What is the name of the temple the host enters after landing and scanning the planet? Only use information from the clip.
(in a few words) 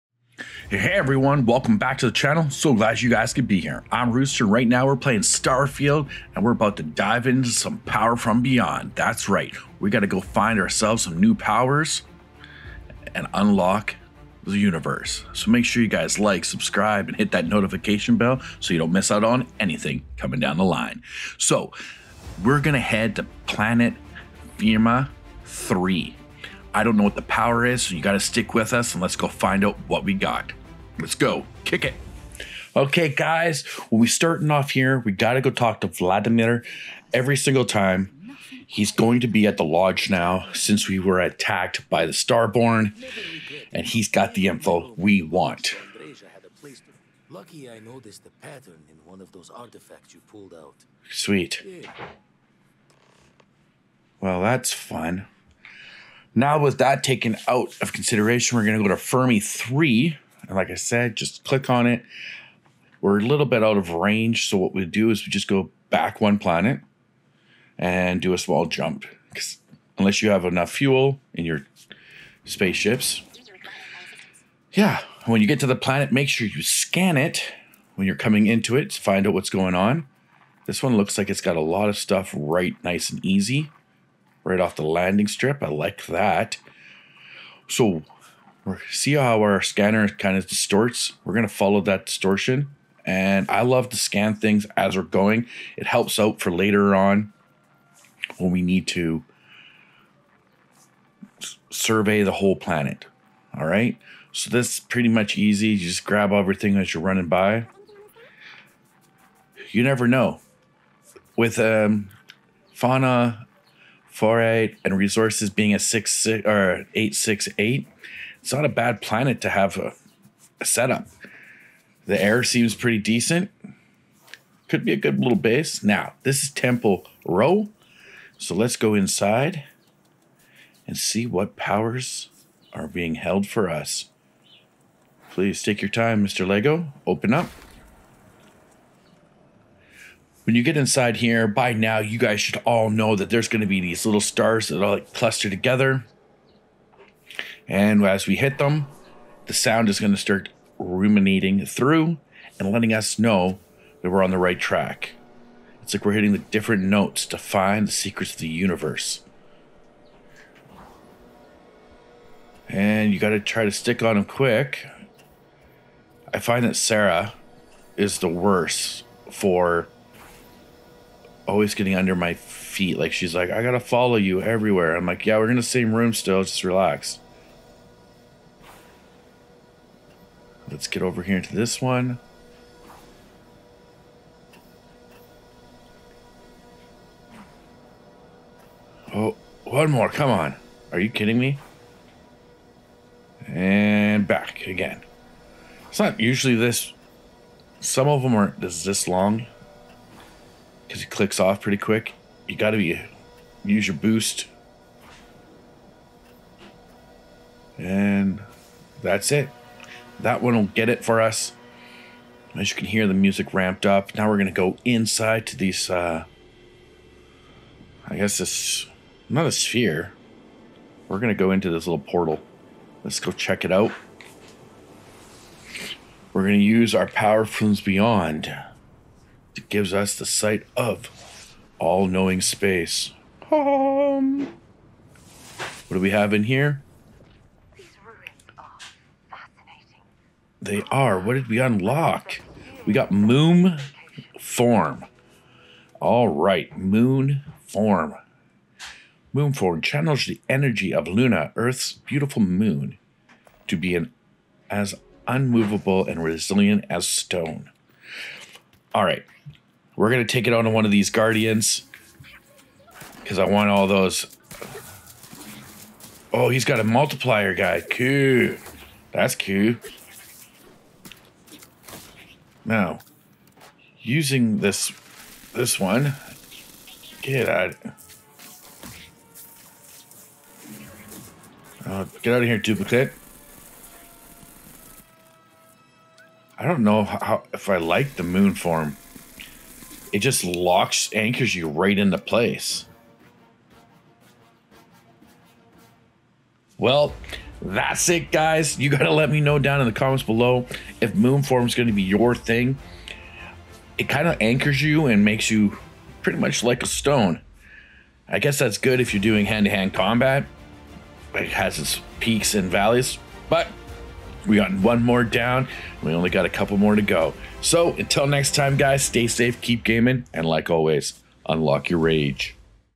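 Temple Rho.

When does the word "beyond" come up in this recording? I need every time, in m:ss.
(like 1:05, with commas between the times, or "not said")
0:08, 3:47.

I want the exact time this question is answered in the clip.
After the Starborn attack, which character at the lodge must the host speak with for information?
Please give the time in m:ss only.
0:35.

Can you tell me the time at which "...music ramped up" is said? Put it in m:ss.
3:33.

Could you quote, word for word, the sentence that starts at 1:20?
This one looks like it's got a lot of stuff right nice and easy right off the landing strip.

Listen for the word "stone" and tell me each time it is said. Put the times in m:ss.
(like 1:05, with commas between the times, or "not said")
4:17, 5:06.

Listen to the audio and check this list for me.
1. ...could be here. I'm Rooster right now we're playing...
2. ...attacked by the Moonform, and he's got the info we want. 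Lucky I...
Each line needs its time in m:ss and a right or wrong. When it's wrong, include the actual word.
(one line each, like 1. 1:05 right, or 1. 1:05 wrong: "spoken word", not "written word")
1. 0:03 right
2. 0:41 wrong: "Starborn", not "Moonform".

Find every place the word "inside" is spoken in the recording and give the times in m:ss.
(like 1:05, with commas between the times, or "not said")
2:08, 2:20, 3:34.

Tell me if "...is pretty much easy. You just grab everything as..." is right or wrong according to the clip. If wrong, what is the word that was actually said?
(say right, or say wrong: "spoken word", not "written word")
right.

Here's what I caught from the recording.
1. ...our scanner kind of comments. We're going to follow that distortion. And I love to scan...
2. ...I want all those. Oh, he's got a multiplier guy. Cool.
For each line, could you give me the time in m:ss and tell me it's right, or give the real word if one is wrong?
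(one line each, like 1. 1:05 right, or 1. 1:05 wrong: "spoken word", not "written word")
1. 1:29 wrong: "distorts", not "comments"
2. 4:23 right.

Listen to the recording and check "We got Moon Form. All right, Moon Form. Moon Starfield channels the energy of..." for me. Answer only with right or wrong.
wrong.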